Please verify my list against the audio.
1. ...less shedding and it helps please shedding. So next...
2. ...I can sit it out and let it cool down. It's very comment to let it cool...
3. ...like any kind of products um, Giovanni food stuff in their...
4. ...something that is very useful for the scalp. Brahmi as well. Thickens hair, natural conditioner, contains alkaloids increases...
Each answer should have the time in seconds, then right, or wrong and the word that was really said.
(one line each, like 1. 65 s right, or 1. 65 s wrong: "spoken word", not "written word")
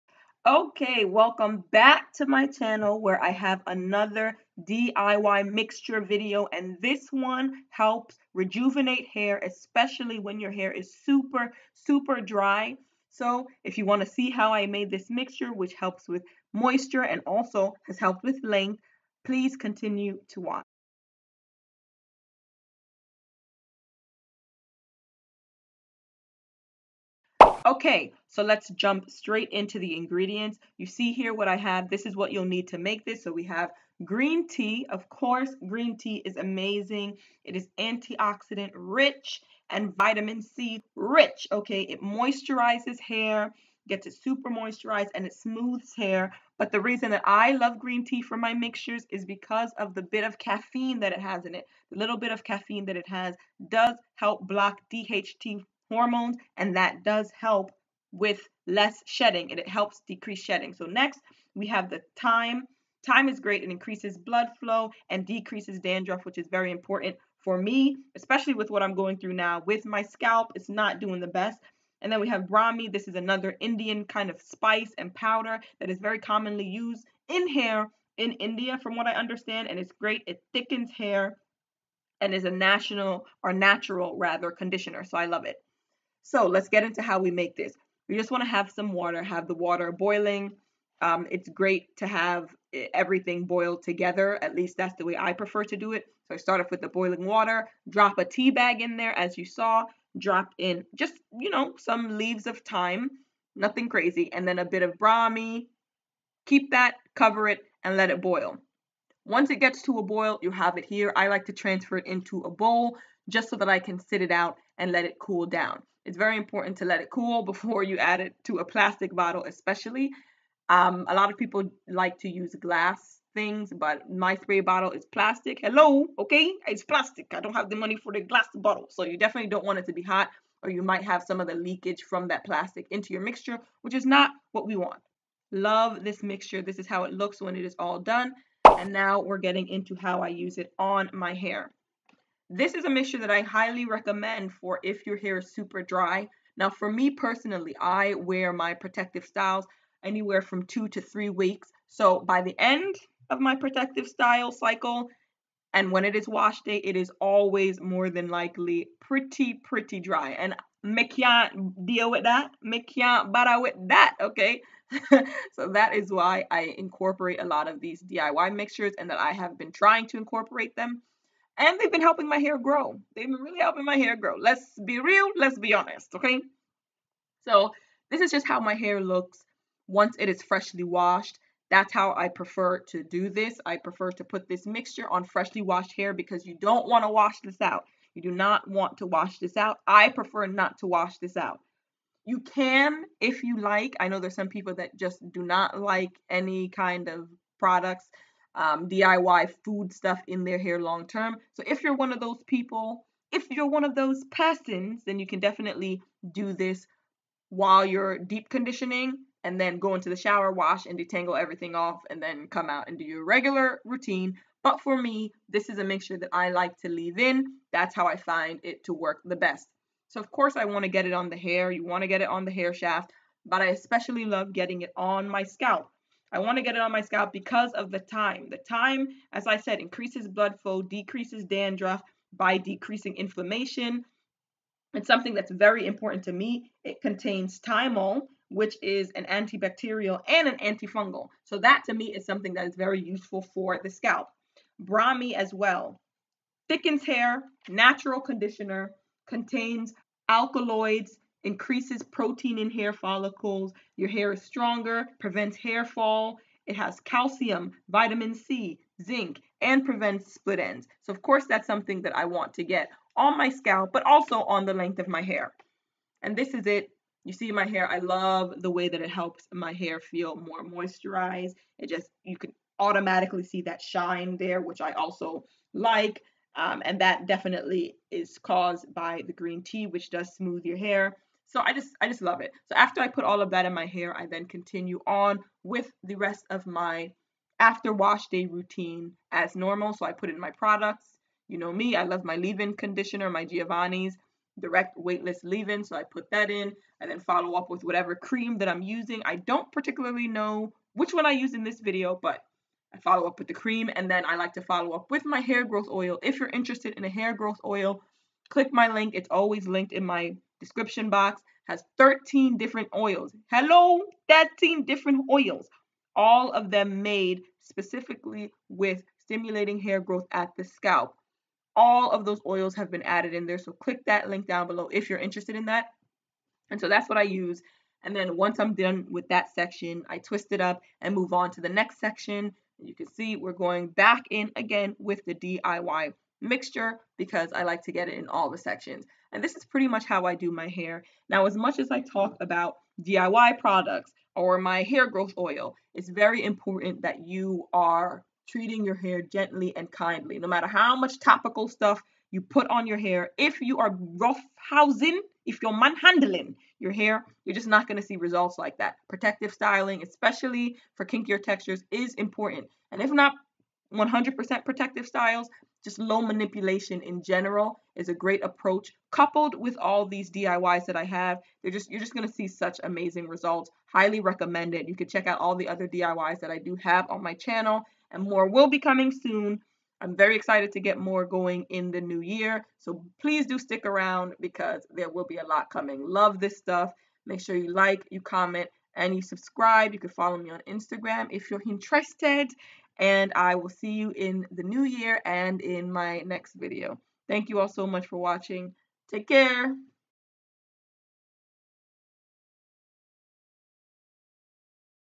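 1. 58 s wrong: "decrease", not "please"
2. 113 s wrong: "important", not "comment"
3. 195 s wrong: "DIY", not "Giovanni"
4. 242 s right.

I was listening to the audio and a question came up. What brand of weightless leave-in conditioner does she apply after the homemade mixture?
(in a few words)
Giovanni.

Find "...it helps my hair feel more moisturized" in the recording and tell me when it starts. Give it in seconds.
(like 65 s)
269 s.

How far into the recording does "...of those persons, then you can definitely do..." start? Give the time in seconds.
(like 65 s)
203 s.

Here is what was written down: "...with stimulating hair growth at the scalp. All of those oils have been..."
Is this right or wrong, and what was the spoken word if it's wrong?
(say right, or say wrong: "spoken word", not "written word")
right.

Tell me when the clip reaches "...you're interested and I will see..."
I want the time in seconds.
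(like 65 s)
391 s.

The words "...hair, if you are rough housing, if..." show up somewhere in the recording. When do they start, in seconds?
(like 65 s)
352 s.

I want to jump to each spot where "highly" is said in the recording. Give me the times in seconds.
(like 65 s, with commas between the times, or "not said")
143 s, 373 s.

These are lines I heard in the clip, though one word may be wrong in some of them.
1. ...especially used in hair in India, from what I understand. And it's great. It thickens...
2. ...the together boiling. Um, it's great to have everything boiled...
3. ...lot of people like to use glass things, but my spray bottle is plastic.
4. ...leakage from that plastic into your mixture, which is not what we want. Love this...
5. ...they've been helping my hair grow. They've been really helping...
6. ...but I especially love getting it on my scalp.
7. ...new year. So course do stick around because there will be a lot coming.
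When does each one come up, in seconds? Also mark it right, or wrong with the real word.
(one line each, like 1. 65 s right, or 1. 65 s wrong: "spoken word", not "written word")
1. 76 s wrong: "commonly", not "especially"
2. 89 s wrong: "water", not "together"
3. 121 s right
4. 131 s right
5. 171 s right
6. 223 s right
7. 382 s wrong: "please", not "course".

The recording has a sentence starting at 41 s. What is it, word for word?
Okay, it moisturizes hair, gets it super moisturized, and it smooths hair.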